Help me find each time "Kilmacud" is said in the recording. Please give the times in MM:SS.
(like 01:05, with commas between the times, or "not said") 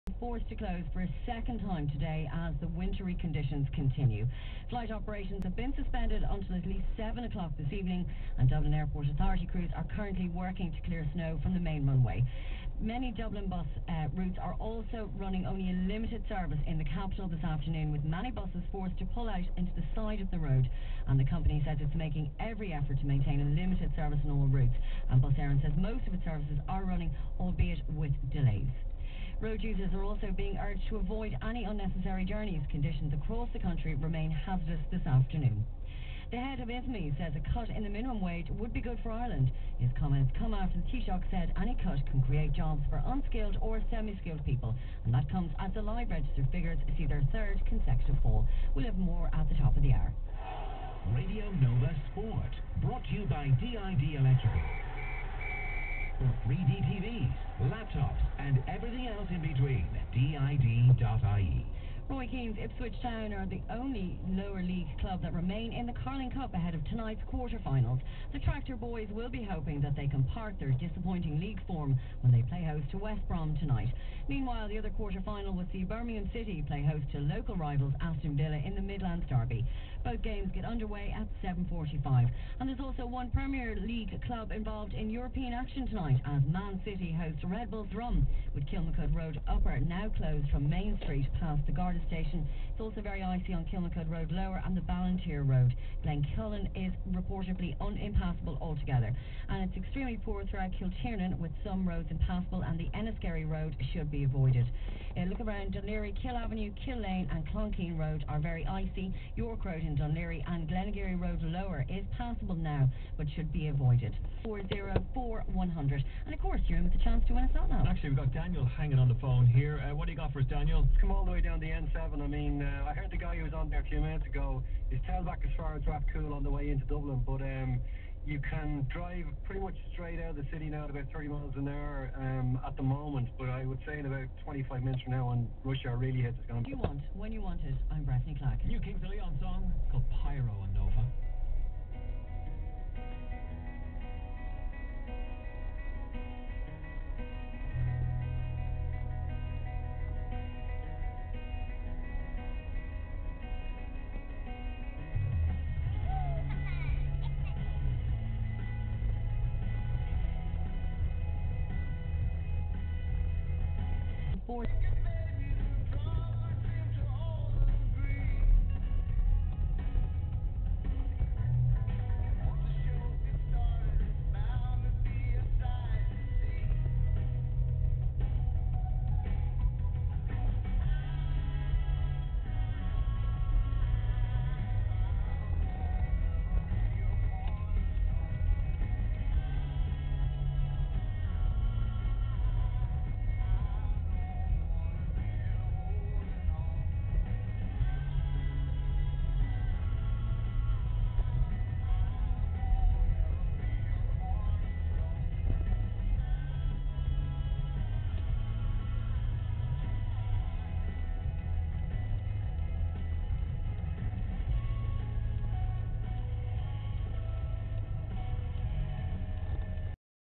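01:28, 01:33.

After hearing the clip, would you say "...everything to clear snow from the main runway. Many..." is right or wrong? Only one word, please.
wrong.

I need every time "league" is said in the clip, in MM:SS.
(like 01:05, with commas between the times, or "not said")
01:04, 01:11, 01:23.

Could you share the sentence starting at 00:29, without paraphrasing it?
Road users are also being urged to avoid any unnecessary journeys.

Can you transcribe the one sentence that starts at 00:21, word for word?
And the company says it's making every effort to maintain a limited service on all routes.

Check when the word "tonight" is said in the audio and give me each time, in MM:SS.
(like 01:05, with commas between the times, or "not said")
01:06, 01:13, 01:25.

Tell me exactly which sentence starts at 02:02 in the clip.
I mean, uh, I heard the guy who was on there a few minutes ago.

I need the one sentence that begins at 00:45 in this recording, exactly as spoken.
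And that comes as the live register figures see their third consecutive fall.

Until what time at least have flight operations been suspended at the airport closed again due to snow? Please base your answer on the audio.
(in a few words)
7 o'clock this evening.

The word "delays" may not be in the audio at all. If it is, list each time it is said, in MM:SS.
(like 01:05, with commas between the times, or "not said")
00:28.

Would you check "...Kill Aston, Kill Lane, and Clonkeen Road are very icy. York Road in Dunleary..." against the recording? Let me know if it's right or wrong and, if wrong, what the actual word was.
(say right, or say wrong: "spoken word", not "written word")
wrong: "Avenue", not "Aston".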